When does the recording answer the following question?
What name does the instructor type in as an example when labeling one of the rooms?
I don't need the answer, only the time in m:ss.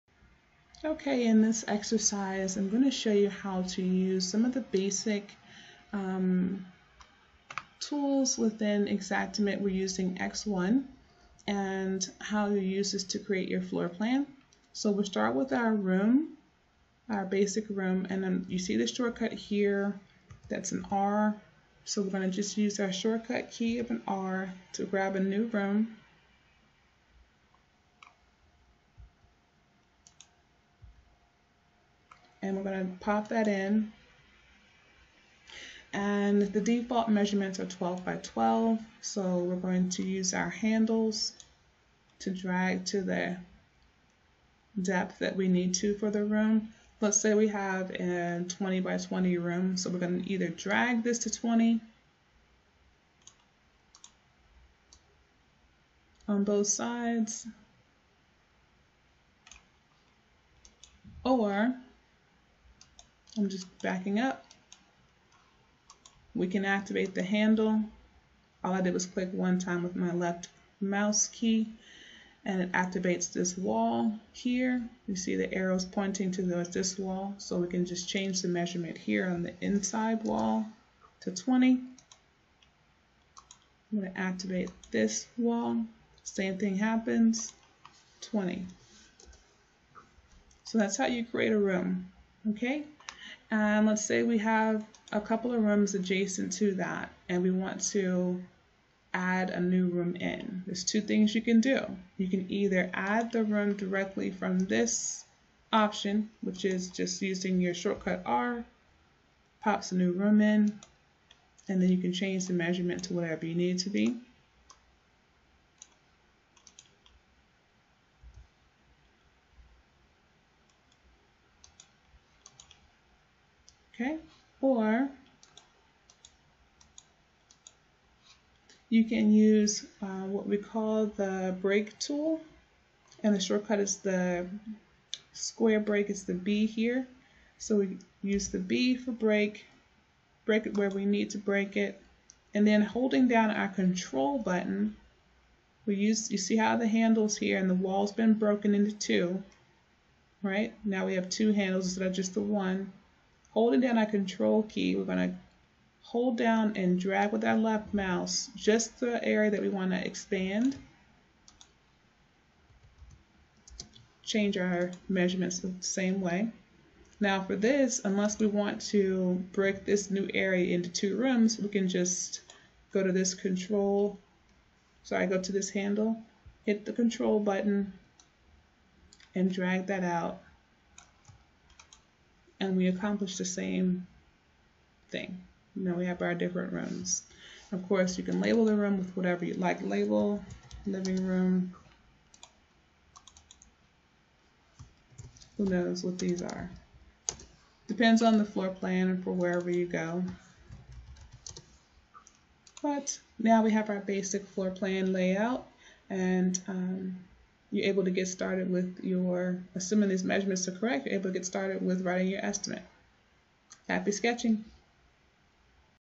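3:10.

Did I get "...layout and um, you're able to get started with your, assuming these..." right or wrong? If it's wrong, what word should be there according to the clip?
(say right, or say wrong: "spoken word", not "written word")
right.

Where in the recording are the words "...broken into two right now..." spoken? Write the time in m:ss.
2:28.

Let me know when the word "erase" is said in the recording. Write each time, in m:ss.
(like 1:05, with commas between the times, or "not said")
not said.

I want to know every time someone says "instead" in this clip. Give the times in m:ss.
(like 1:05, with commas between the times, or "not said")
2:31.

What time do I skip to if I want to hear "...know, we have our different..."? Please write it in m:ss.
3:05.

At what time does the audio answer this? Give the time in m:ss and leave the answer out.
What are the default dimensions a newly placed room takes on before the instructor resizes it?
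0:37.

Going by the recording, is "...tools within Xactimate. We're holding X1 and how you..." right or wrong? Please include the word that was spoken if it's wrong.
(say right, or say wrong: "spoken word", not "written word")
wrong: "using", not "holding".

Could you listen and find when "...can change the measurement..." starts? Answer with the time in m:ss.
1:51.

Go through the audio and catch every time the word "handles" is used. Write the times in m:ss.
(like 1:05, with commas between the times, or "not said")
0:40, 1:07, 2:26, 2:31, 2:55.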